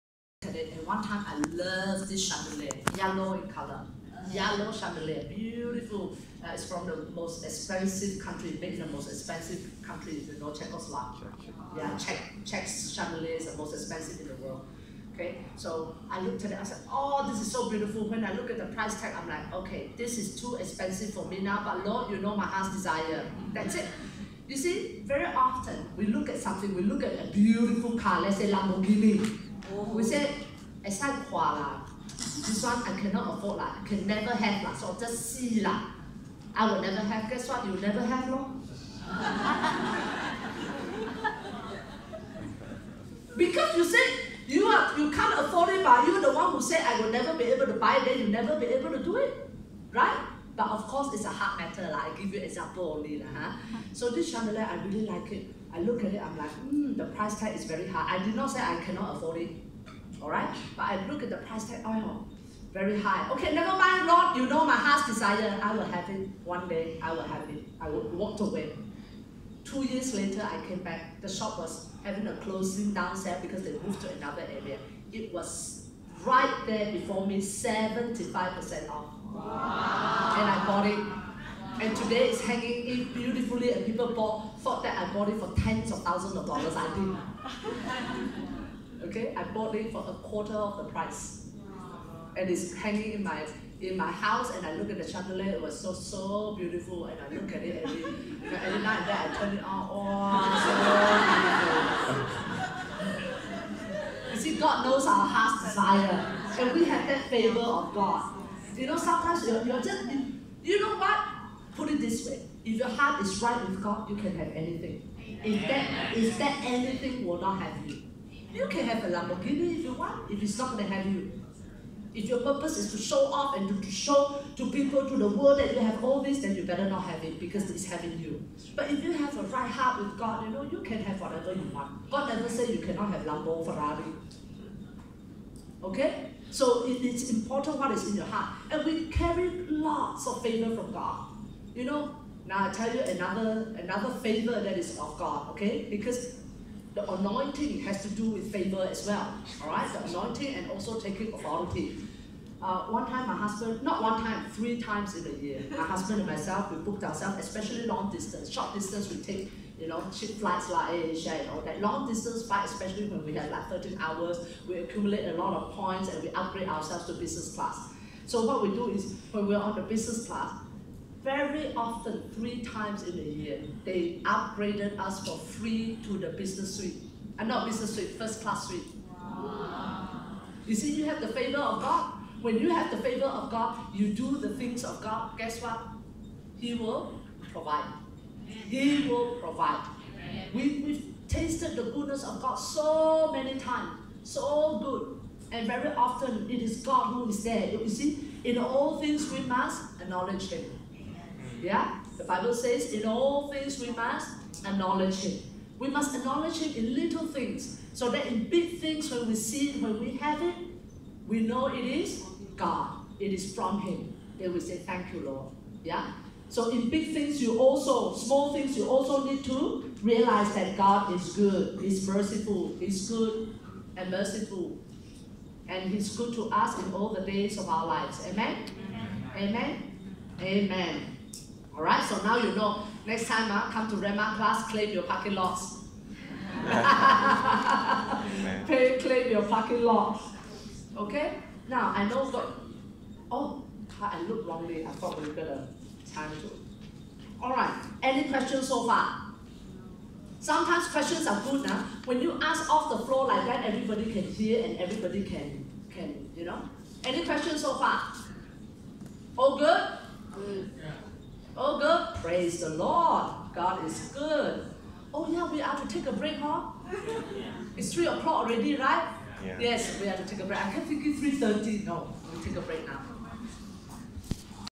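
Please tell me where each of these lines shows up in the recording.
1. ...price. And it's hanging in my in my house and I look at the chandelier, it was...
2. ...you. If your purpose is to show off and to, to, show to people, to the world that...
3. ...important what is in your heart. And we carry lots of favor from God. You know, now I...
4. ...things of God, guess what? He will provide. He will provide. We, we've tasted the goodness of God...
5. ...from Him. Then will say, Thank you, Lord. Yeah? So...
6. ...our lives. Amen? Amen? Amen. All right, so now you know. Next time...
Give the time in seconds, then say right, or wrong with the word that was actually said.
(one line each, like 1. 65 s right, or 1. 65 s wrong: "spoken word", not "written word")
1. 90 s right
2. 121 s right
3. 137 s right
4. 184 s right
5. 213 s right
6. 227 s right.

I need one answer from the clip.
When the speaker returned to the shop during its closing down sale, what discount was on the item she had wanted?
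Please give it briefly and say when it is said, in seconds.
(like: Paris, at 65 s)
75% off, at 77 s.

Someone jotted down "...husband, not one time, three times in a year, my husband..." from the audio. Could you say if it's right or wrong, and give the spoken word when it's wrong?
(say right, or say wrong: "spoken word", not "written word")
right.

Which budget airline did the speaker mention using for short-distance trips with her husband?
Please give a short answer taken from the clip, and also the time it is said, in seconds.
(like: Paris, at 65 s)
AirAsia, at 160 s.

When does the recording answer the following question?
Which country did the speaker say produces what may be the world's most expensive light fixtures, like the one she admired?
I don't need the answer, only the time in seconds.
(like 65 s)
10 s.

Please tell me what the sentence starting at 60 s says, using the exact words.
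But I look at the price tag, oh, very high.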